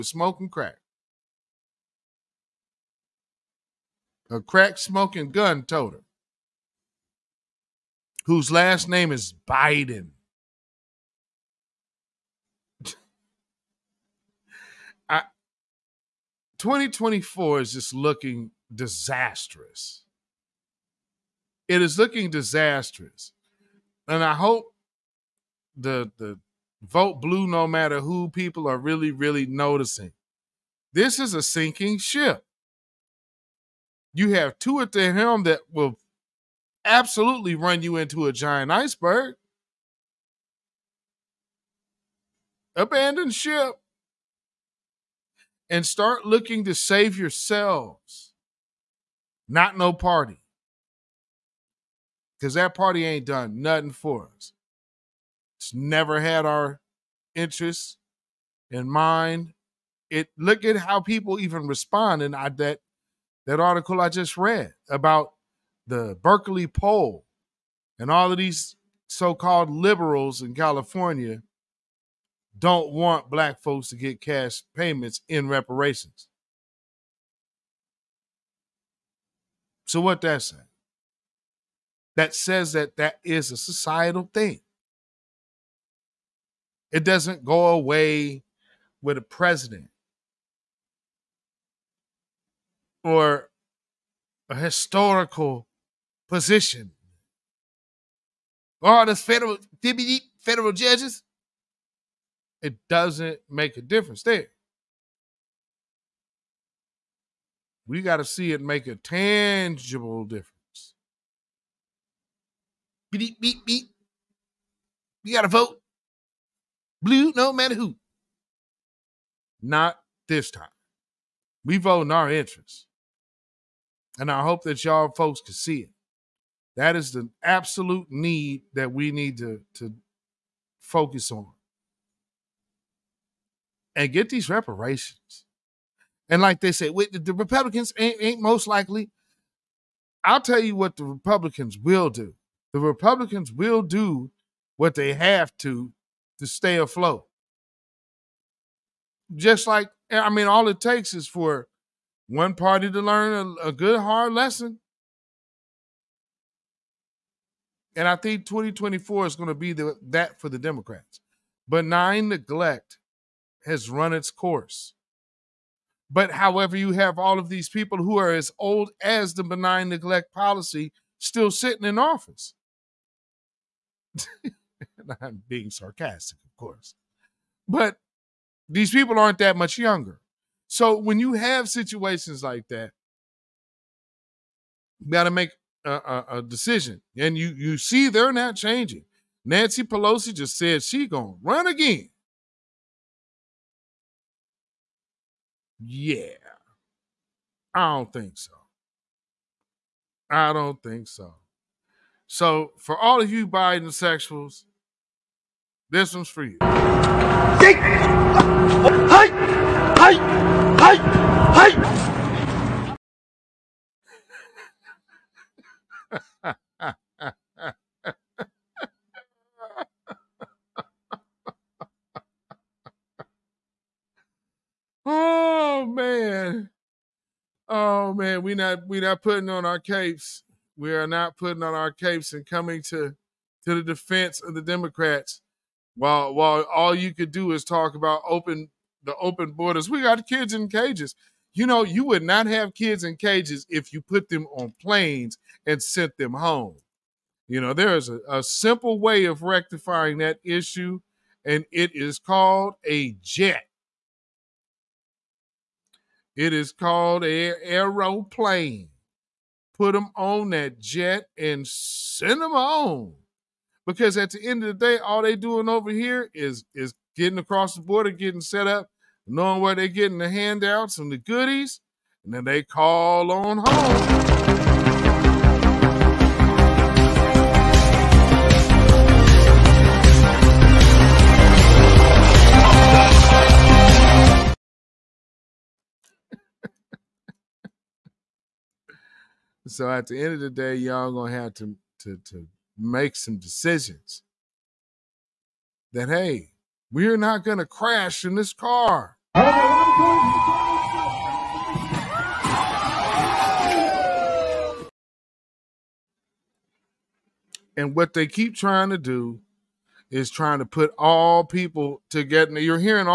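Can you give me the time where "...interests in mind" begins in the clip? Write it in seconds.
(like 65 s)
57 s.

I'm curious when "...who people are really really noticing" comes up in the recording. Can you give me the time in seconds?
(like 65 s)
28 s.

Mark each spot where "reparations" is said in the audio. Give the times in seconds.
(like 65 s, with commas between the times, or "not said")
75 s, 134 s.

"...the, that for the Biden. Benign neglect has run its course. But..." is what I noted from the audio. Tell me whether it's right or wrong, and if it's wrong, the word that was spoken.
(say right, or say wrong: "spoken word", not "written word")
wrong: "Democrats", not "Biden".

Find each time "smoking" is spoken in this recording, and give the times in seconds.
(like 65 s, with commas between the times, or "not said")
0 s, 4 s.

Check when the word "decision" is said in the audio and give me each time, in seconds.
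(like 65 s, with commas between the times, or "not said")
186 s, 293 s.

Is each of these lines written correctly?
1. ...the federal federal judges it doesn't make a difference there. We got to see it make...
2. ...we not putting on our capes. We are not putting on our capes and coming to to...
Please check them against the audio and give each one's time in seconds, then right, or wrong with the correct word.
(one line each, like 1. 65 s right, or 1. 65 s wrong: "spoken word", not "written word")
1. 99 s right
2. 228 s right.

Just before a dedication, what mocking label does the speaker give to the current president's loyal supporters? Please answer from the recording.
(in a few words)
Biden sexuals.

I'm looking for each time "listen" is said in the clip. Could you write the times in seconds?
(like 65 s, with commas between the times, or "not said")
not said.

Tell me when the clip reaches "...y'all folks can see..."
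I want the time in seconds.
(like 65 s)
124 s.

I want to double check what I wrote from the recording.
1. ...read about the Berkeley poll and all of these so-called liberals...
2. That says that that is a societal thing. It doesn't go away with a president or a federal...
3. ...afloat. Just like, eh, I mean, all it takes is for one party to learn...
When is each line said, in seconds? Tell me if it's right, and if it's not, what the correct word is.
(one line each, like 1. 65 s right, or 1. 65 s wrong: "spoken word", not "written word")
1. 64 s right
2. 82 s wrong: "historical", not "federal"
3. 146 s right.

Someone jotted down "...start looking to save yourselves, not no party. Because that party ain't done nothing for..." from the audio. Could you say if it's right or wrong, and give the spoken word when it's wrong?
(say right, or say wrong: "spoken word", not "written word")
right.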